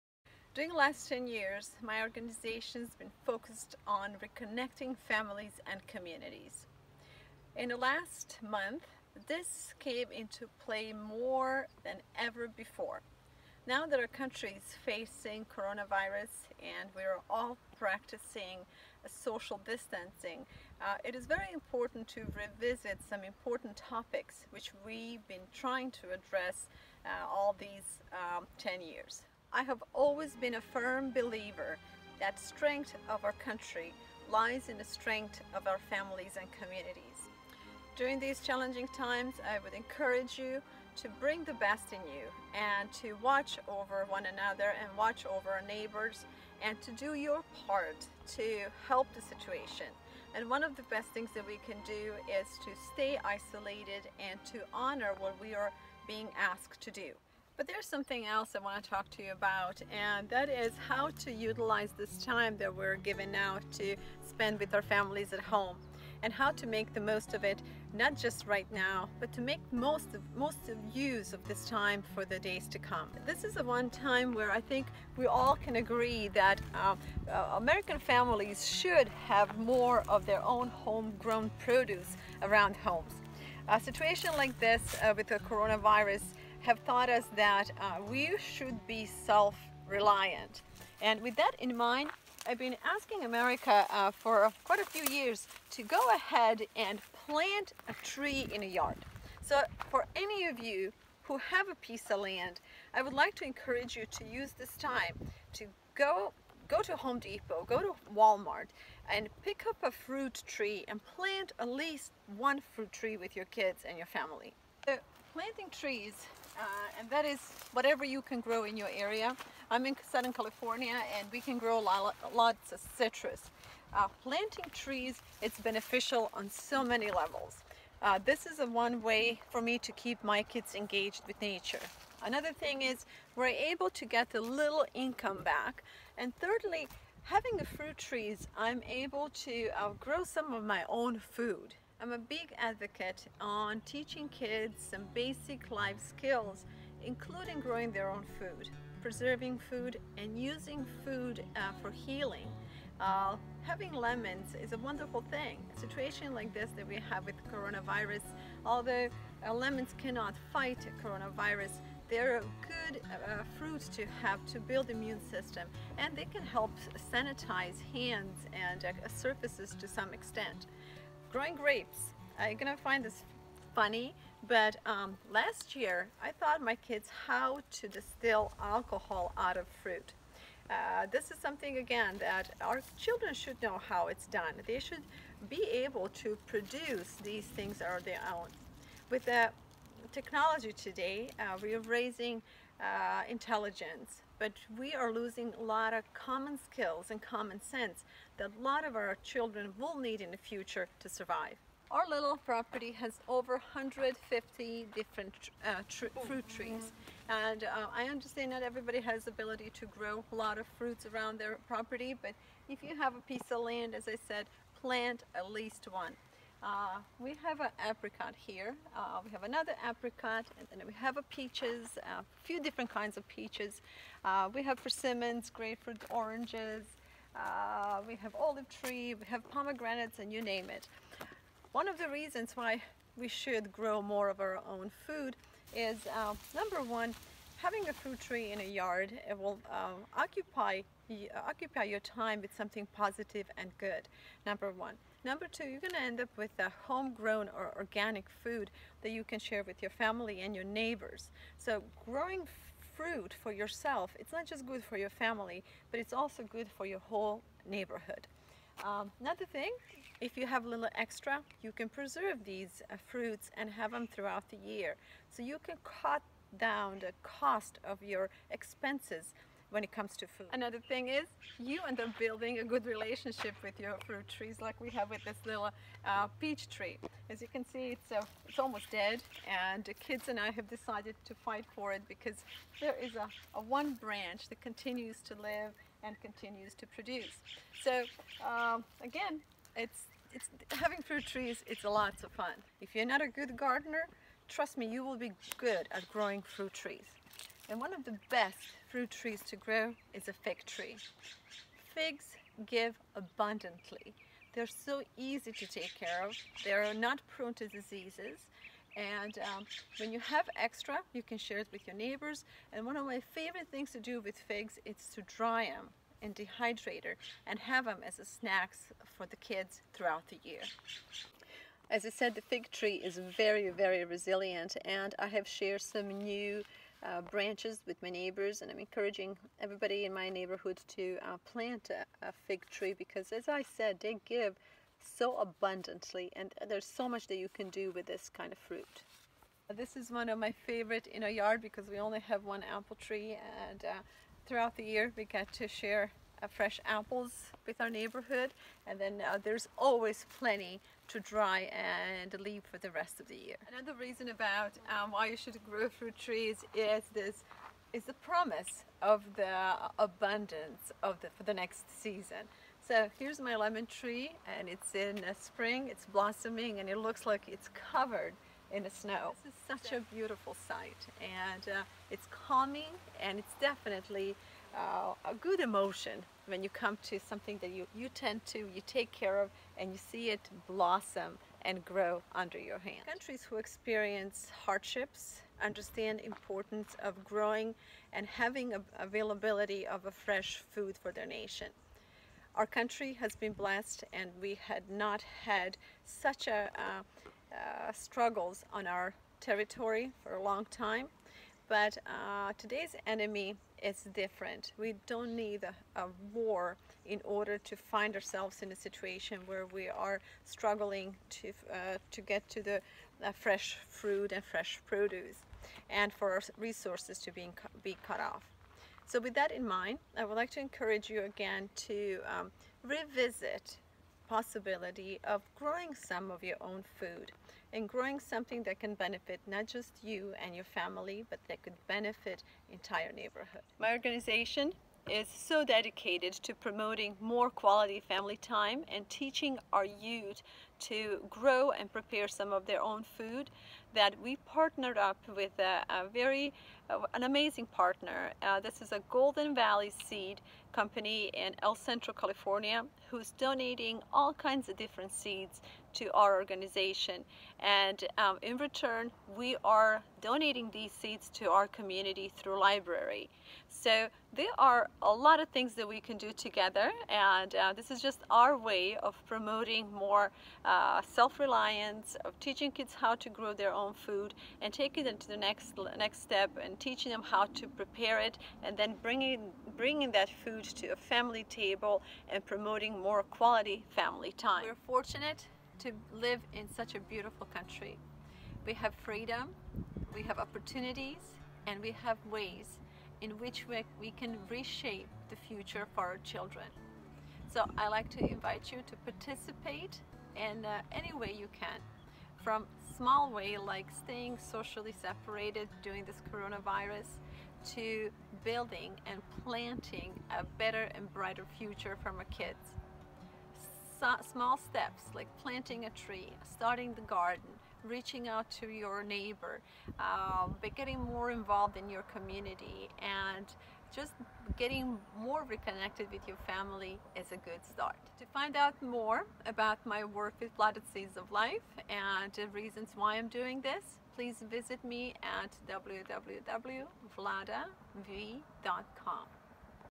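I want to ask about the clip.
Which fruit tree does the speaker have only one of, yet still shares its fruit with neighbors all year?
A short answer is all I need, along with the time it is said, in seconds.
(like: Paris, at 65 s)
apple tree, at 342 s.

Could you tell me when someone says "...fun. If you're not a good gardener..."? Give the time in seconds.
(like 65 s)
292 s.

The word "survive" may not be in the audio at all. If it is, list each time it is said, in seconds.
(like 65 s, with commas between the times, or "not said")
201 s.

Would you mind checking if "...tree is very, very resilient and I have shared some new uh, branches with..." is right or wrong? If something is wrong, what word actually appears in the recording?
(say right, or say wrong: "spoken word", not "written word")
right.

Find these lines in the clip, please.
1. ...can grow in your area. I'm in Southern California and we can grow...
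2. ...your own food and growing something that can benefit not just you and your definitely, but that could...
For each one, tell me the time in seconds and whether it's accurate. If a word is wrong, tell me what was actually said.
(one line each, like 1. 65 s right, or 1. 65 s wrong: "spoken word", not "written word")
1. 118 s right
2. 426 s wrong: "family", not "definitely".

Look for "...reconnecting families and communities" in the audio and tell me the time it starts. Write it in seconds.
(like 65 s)
4 s.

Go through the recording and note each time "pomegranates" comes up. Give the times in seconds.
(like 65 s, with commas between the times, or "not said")
229 s.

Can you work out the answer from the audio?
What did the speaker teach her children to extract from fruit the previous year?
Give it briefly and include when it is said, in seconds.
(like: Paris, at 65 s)
alcohol, at 178 s.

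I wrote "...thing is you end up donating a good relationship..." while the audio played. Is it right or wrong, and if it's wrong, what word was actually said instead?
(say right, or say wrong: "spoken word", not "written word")
wrong: "building", not "donating".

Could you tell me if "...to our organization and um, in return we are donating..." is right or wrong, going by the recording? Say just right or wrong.
right.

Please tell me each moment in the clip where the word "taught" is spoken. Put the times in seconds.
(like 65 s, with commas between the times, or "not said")
86 s, 176 s.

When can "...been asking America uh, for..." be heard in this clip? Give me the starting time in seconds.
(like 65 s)
92 s.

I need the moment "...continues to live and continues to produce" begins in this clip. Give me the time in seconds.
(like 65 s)
284 s.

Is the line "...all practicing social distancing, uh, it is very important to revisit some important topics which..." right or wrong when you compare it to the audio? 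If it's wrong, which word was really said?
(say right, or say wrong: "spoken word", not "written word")
right.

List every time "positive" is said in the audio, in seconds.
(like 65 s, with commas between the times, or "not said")
242 s.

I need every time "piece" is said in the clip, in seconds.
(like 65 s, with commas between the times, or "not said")
101 s, 213 s.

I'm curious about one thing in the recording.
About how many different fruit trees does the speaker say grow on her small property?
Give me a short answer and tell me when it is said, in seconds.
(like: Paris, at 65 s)
over 150, at 203 s.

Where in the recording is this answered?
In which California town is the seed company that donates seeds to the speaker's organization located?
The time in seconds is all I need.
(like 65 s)
451 s.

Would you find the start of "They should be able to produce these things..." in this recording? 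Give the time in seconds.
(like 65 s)
184 s.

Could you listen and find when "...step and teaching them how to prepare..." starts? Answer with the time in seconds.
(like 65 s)
476 s.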